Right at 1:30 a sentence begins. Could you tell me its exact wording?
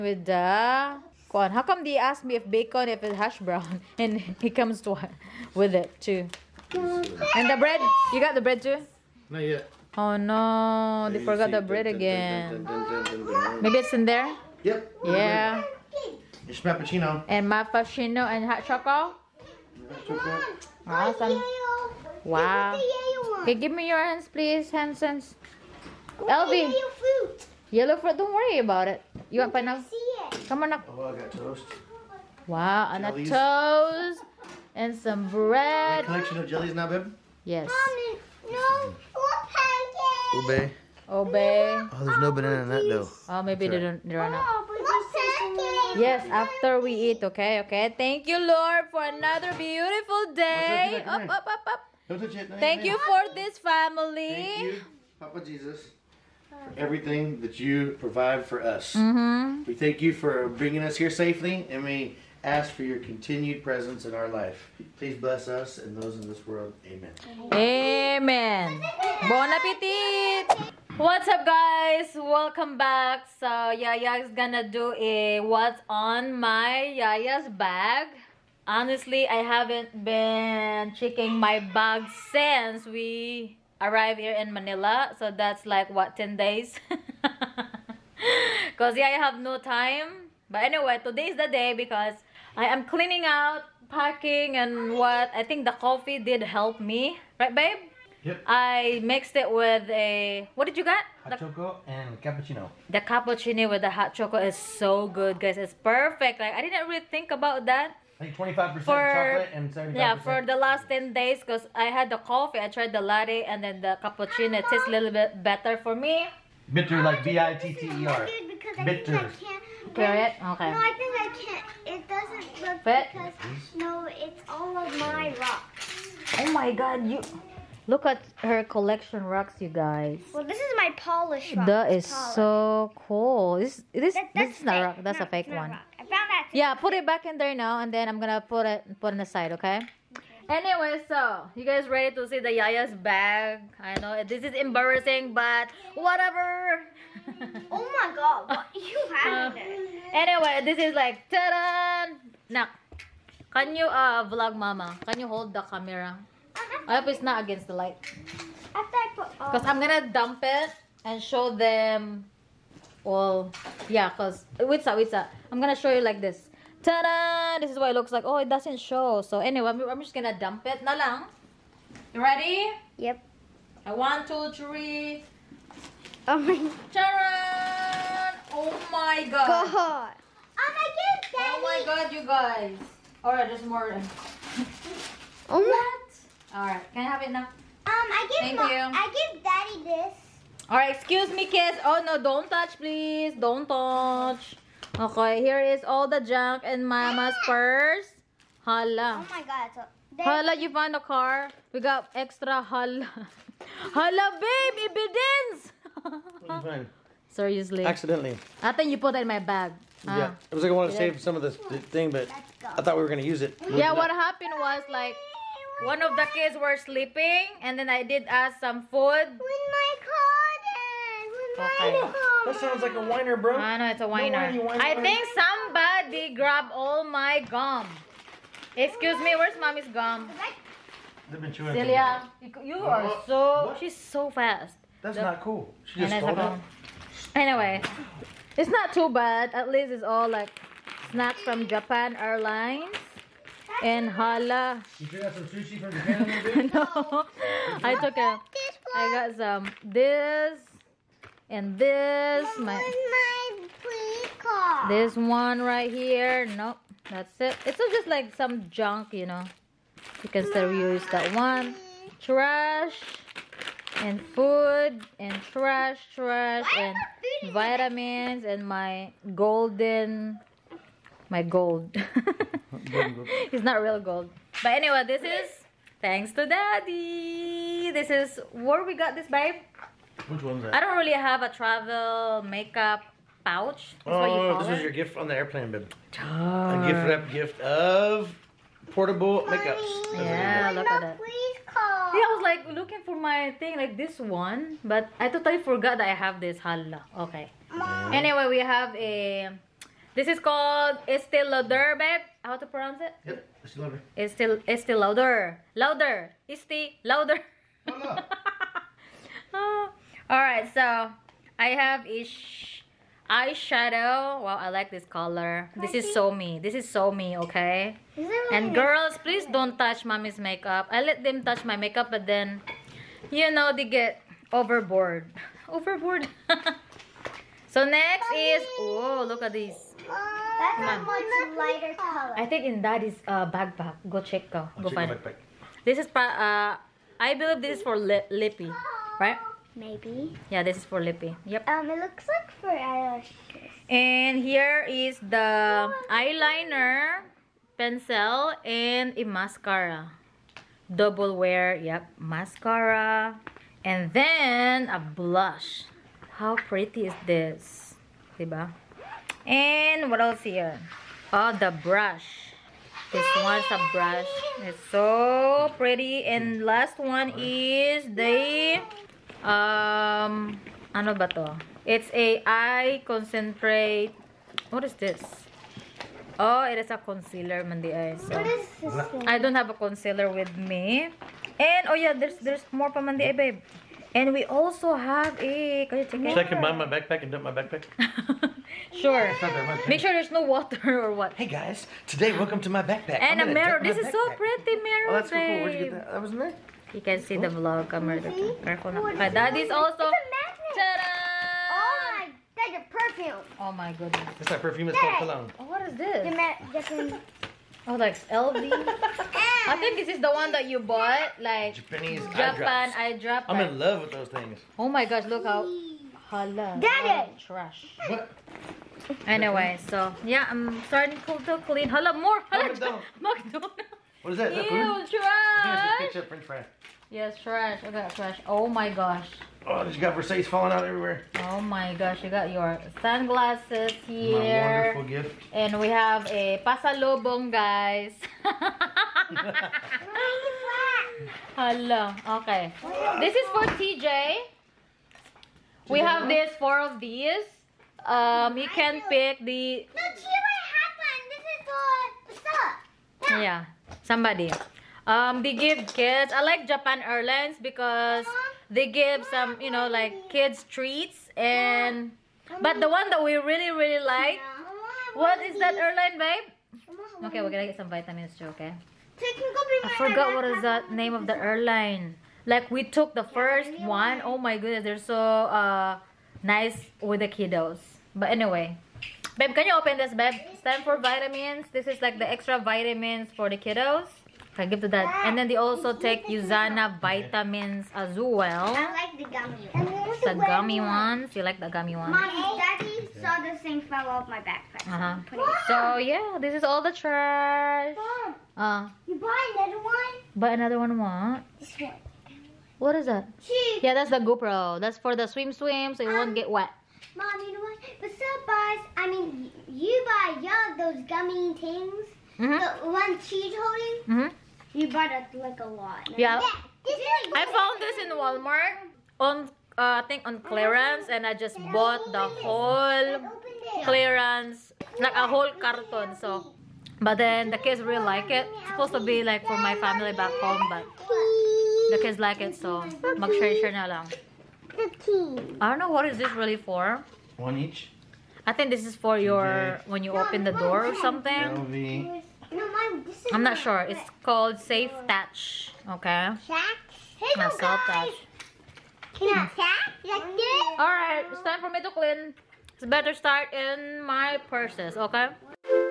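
But anyway, today is the day because I am cleaning out, packing and what I think the coffee did help me.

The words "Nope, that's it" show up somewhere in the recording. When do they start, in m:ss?
4:16.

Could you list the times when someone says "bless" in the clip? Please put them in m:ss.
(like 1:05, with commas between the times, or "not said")
1:05.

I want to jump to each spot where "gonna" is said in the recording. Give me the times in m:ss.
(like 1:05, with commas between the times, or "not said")
1:14, 2:18, 2:39, 2:45, 2:50, 3:33, 7:47.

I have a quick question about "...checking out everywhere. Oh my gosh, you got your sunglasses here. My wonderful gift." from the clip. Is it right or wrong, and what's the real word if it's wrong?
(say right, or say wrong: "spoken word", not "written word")
wrong: "falling", not "checking".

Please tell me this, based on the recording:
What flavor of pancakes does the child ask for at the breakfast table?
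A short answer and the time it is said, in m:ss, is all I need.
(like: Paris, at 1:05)
Ube, at 0:40.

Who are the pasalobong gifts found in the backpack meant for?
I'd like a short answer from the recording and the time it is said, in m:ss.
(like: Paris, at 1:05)
TJ, at 7:23.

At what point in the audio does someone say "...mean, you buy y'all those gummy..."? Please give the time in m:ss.
8:29.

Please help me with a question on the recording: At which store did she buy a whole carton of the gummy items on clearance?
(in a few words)
Walmart.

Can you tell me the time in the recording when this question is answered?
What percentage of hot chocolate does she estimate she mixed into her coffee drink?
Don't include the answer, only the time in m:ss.
1:48.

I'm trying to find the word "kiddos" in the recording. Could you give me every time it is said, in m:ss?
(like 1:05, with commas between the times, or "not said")
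7:57, 8:03.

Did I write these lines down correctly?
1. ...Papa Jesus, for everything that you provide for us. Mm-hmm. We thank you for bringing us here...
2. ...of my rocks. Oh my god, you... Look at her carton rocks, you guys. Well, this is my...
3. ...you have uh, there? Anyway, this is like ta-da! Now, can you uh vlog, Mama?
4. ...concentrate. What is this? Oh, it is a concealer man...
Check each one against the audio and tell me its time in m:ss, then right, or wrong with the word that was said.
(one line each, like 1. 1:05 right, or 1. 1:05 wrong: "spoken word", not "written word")
1. 0:55 right
2. 2:04 wrong: "collection", not "carton"
3. 2:28 right
4. 6:13 right.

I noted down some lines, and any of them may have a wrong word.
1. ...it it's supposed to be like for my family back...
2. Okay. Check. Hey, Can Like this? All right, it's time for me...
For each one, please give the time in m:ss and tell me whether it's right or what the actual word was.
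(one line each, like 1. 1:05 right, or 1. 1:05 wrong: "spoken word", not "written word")
1. 8:48 right
2. 9:05 right.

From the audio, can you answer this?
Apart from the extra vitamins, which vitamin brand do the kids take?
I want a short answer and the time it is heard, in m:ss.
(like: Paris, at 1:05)
Usana, at 8:06.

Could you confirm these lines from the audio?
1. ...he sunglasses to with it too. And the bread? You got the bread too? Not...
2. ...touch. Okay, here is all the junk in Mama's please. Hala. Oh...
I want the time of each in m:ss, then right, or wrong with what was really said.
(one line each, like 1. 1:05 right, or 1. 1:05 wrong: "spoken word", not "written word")
1. 0:04 wrong: "comes", not "sunglasses"
2. 3:13 wrong: "purse", not "please".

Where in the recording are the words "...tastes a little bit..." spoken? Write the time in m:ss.
1:54.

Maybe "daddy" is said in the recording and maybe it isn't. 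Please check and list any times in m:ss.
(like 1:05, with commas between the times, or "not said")
3:01, 3:09, 4:36, 8:12.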